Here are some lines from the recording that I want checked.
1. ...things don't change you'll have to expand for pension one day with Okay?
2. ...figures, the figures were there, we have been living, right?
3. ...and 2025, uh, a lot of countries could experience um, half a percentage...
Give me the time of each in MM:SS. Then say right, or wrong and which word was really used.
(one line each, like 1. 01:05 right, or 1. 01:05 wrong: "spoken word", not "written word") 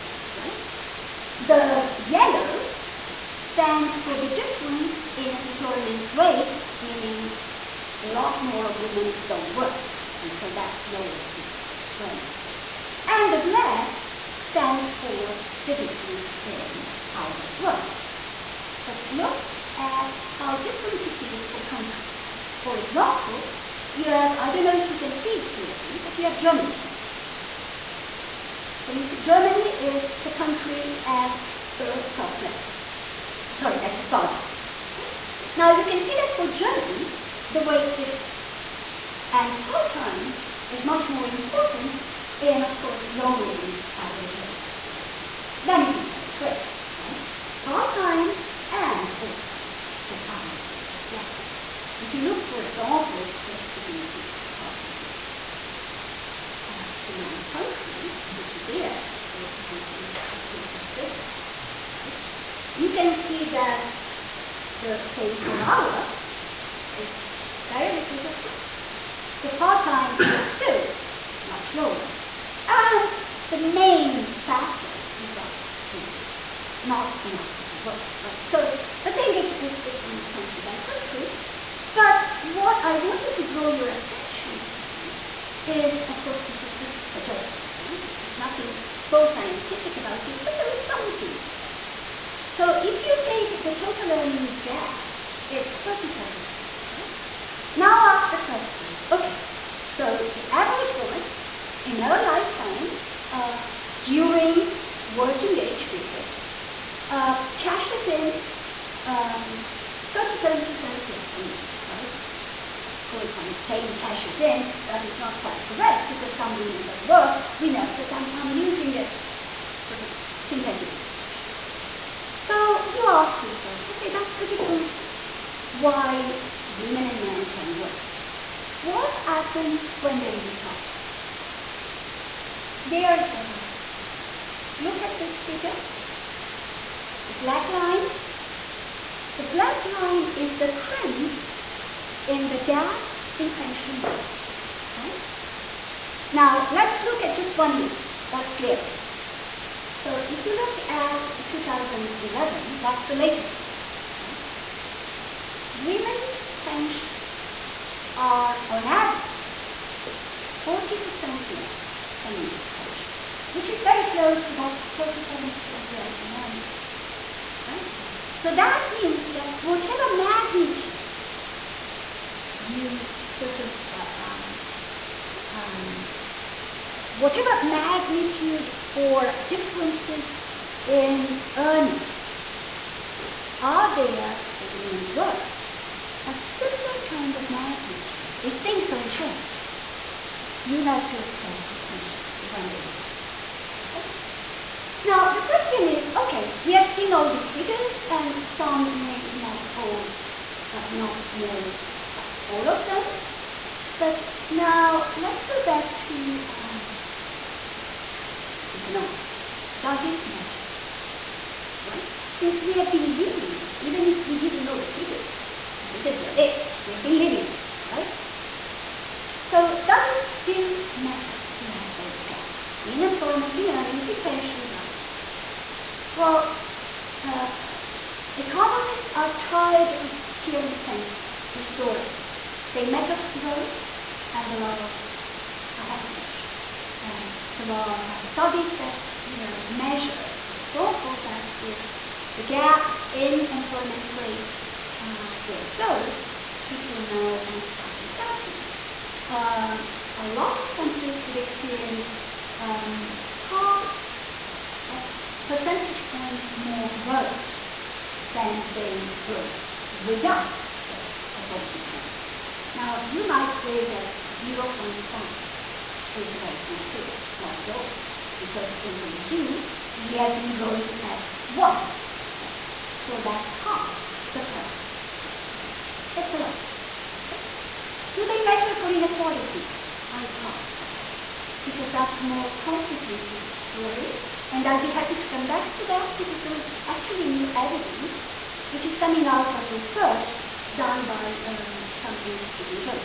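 1. 03:08 right
2. 03:34 right
3. 04:07 wrong: "2030", not "2025".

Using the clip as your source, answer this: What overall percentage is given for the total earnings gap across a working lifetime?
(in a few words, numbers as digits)
37%.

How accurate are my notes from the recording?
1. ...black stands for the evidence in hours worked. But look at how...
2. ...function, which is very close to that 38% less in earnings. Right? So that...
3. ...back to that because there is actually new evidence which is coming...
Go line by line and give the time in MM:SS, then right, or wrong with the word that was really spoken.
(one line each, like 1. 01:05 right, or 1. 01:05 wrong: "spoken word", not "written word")
1. 00:13 wrong: "difference", not "evidence"
2. 02:42 wrong: "37", not "38"
3. 04:45 right.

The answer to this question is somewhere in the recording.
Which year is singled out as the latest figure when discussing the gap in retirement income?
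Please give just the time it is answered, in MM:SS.
02:31.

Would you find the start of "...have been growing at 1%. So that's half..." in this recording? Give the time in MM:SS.
04:30.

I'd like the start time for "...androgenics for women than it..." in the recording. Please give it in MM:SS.
00:43.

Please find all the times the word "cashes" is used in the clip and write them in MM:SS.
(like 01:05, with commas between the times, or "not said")
01:47, 01:53.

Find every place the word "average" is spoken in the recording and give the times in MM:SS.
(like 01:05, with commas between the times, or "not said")
01:40, 02:38.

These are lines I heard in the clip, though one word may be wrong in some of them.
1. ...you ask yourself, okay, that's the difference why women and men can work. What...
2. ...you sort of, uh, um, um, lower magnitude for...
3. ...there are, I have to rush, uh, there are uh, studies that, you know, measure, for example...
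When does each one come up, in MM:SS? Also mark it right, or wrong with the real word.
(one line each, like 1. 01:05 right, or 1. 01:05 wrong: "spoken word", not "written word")
1. 02:02 right
2. 02:52 wrong: "whatever", not "lower"
3. 03:54 right.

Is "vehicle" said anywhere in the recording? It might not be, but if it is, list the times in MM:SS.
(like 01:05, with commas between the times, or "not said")
not said.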